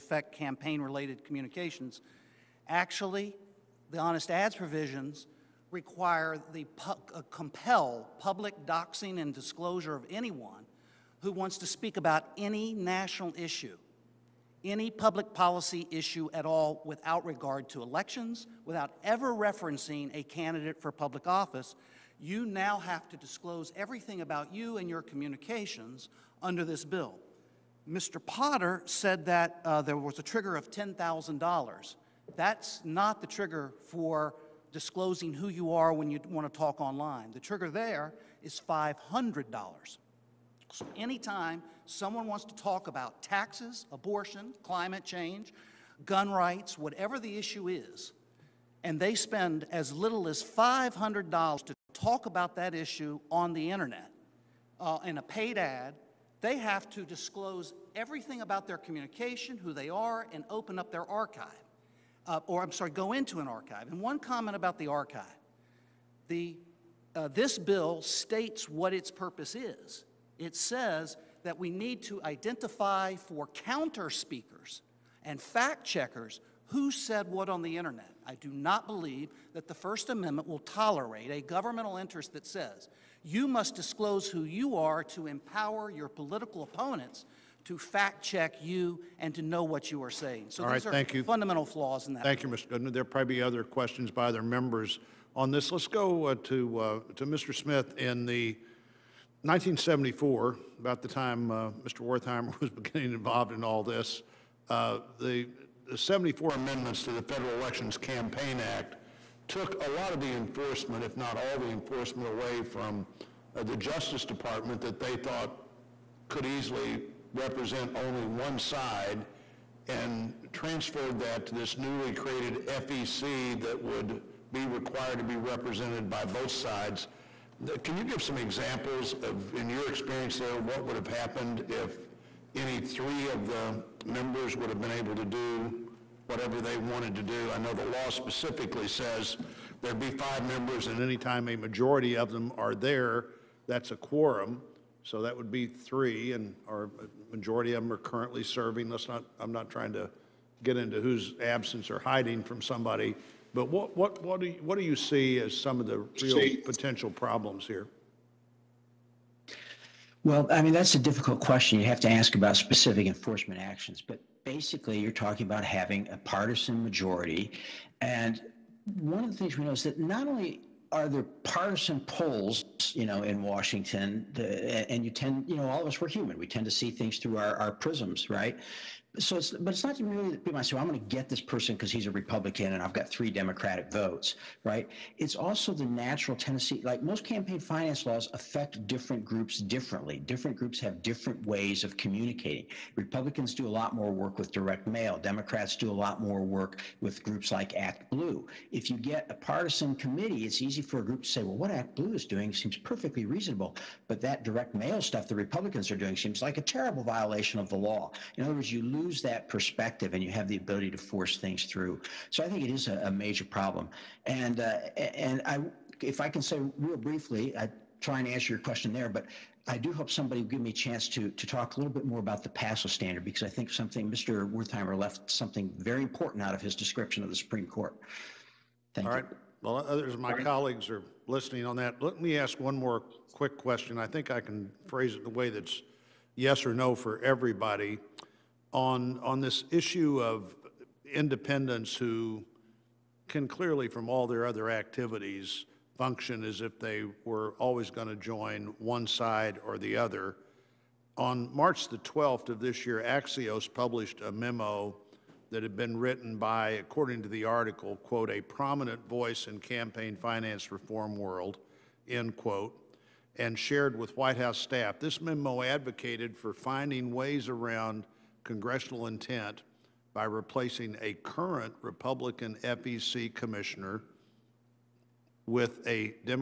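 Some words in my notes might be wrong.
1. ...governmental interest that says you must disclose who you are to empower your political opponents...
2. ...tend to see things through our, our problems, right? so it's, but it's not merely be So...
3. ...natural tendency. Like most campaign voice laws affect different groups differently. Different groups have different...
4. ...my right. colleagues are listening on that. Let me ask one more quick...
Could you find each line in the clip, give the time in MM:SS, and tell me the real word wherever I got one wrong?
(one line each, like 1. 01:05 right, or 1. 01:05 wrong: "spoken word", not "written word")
1. 01:21 right
2. 02:56 wrong: "prisms", not "problems"
3. 03:05 wrong: "finance", not "voice"
4. 03:50 right.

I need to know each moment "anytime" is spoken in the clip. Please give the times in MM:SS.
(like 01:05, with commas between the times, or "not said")
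00:40, 02:21.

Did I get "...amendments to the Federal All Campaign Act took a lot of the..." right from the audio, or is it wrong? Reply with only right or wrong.
wrong.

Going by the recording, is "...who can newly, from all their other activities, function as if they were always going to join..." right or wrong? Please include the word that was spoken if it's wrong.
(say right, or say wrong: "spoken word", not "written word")
wrong: "clearly", not "newly".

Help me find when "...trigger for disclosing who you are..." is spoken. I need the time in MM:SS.
00:33.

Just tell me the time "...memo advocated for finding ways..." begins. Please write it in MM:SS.
04:25.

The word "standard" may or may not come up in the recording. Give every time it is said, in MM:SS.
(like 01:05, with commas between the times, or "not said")
03:42.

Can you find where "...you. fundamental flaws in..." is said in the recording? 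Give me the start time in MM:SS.
01:31.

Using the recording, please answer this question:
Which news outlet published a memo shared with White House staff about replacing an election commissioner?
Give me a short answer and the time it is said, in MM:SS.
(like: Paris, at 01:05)
Axios, at 04:13.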